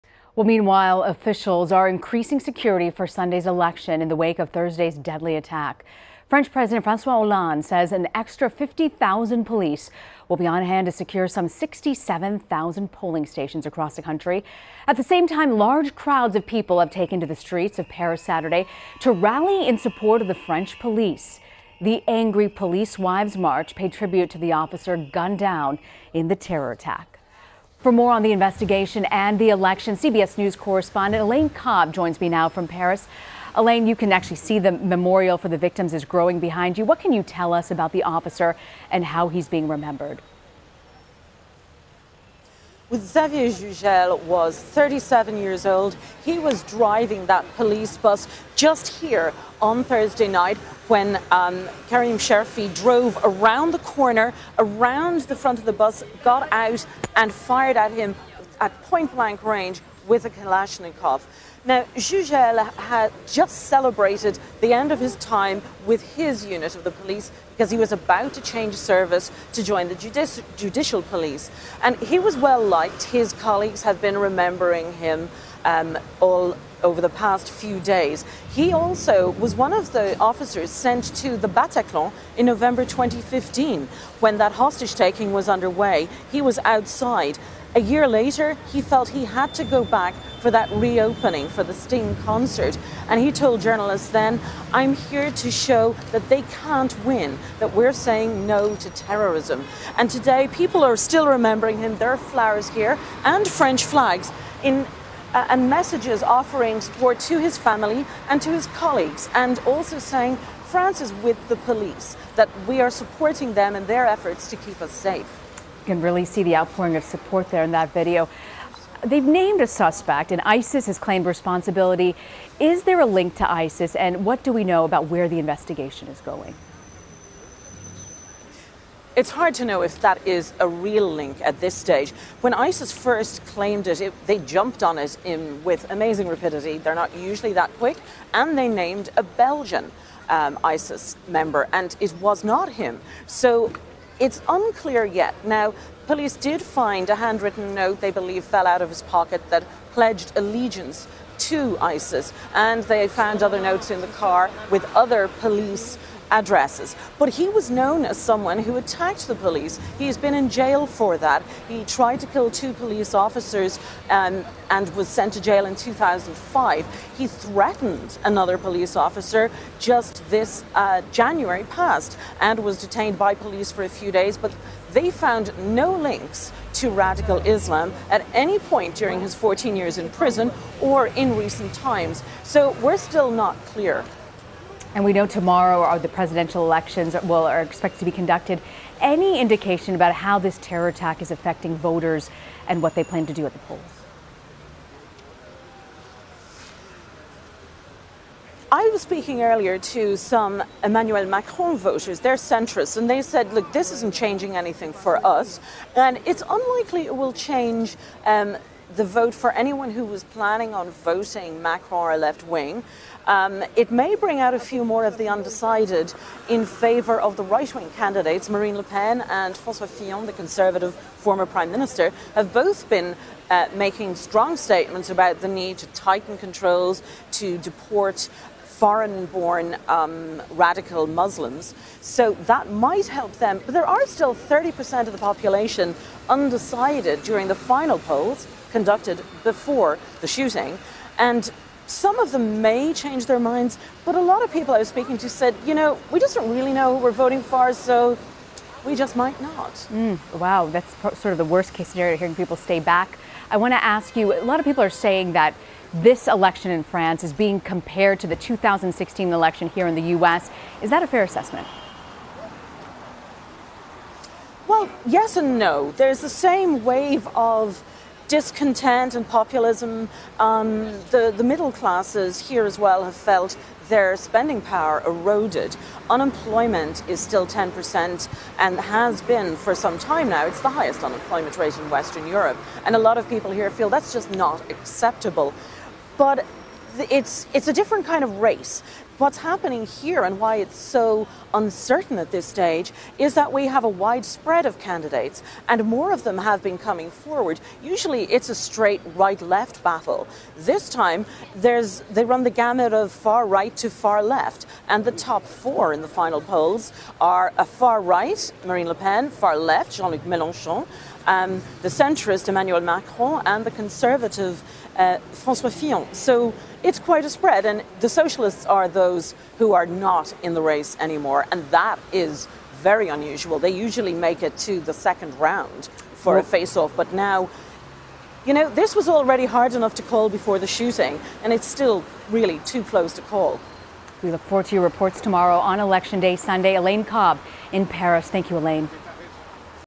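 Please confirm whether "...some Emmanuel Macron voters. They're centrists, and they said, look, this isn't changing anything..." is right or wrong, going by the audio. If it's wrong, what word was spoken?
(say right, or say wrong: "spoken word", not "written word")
right.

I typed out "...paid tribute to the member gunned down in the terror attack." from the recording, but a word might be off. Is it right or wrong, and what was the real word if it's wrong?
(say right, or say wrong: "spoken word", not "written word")
wrong: "officer", not "member".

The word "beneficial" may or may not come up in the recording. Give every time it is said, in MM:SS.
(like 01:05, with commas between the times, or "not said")
not said.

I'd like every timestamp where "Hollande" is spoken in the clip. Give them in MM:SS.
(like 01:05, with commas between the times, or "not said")
00:07.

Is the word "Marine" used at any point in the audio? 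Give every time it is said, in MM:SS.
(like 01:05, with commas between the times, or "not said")
03:38, 05:08.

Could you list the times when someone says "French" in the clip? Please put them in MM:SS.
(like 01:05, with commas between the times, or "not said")
00:06, 00:20, 01:43.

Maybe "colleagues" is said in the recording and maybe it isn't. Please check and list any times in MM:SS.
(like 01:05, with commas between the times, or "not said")
01:13, 01:48.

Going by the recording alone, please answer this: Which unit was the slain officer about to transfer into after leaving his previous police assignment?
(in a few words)
judicial police.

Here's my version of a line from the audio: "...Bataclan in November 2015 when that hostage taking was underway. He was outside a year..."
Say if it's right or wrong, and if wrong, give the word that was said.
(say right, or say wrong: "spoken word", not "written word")
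right.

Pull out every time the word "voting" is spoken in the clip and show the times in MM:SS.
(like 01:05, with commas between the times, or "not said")
03:30, 04:07.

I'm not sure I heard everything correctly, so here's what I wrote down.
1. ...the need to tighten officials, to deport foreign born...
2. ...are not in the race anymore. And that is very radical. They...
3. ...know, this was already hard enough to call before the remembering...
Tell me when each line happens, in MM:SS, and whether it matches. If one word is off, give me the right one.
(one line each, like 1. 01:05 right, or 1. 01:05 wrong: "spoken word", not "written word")
1. 03:45 wrong: "controls", not "officials"
2. 05:19 wrong: "unusual", not "radical"
3. 05:28 wrong: "shooting", not "remembering".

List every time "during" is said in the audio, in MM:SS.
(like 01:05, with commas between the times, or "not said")
02:58, 03:57.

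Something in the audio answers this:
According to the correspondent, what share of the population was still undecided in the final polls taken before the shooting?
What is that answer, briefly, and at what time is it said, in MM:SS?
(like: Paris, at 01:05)
30%, at 03:54.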